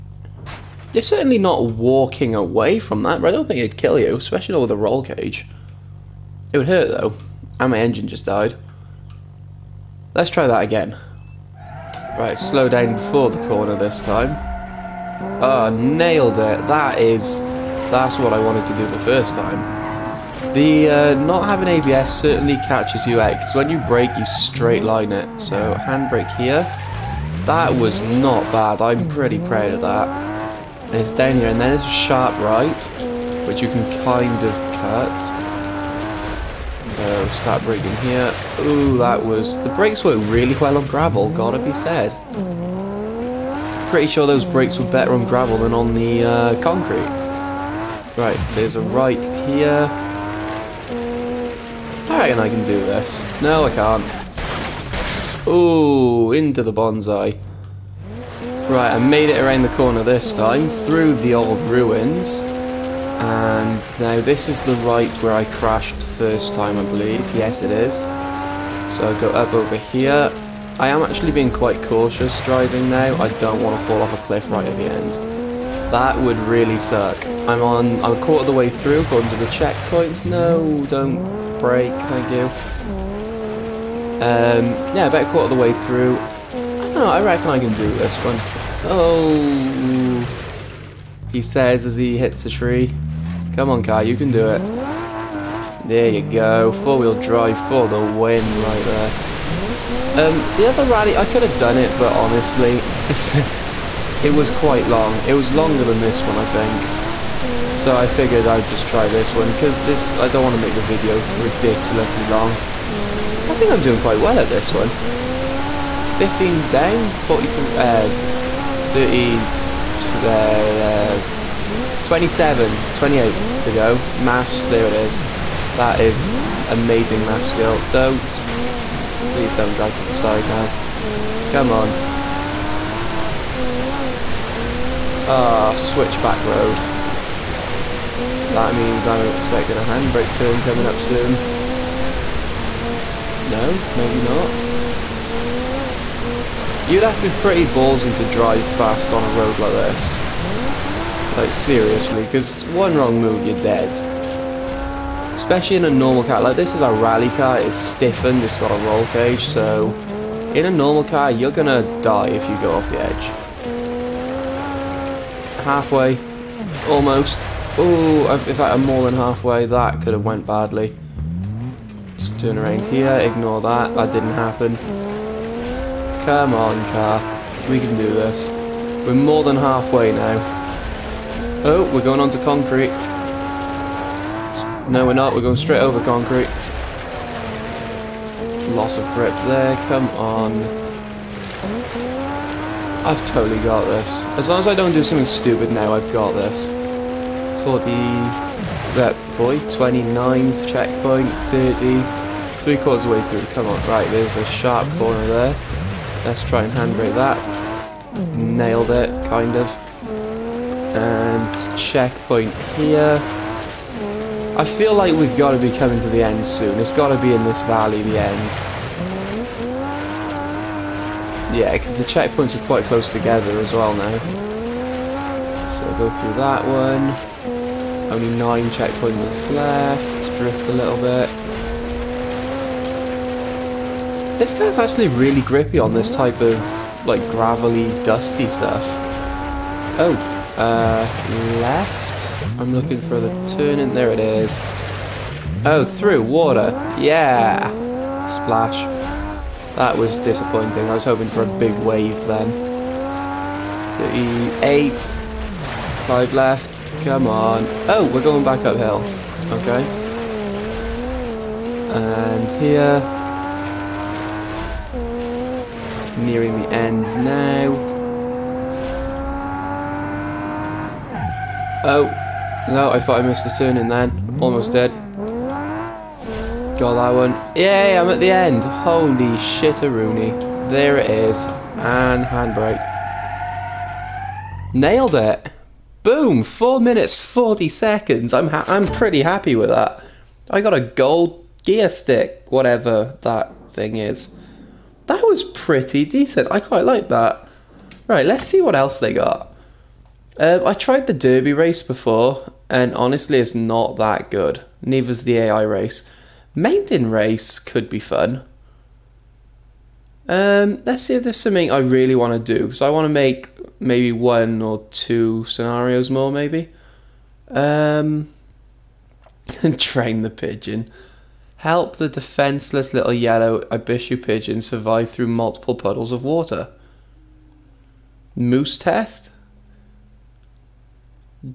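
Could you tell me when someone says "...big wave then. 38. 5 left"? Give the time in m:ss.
4:11.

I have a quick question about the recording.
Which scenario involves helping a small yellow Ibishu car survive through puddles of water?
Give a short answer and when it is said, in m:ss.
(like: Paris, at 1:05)
train the pigeon, at 5:19.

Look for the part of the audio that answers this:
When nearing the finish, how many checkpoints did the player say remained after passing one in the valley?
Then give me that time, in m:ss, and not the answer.
3:48.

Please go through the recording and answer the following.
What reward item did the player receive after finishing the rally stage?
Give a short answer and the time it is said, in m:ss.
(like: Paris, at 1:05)
gold gear stick, at 4:50.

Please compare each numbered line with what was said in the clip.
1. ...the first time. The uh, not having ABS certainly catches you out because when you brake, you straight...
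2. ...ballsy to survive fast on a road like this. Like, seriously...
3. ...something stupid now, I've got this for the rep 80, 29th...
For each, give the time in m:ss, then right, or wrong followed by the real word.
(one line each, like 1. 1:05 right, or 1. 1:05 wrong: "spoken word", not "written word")
1. 0:18 right
2. 2:27 wrong: "drive", not "survive"
3. 3:15 wrong: "40", not "80".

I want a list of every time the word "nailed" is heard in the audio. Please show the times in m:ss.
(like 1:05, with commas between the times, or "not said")
0:15, 3:28, 4:44.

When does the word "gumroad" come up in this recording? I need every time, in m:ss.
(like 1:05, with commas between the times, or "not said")
not said.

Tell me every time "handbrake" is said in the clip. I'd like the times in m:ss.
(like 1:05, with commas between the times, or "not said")
0:25, 2:19, 3:26, 4:42.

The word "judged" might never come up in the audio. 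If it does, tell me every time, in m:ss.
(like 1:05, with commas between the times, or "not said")
not said.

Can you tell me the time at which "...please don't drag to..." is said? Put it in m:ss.
2:09.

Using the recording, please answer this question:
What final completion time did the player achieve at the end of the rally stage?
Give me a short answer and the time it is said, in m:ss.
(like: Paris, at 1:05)
4 minutes 40 seconds, at 4:46.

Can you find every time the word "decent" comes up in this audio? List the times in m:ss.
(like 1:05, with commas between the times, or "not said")
4:56.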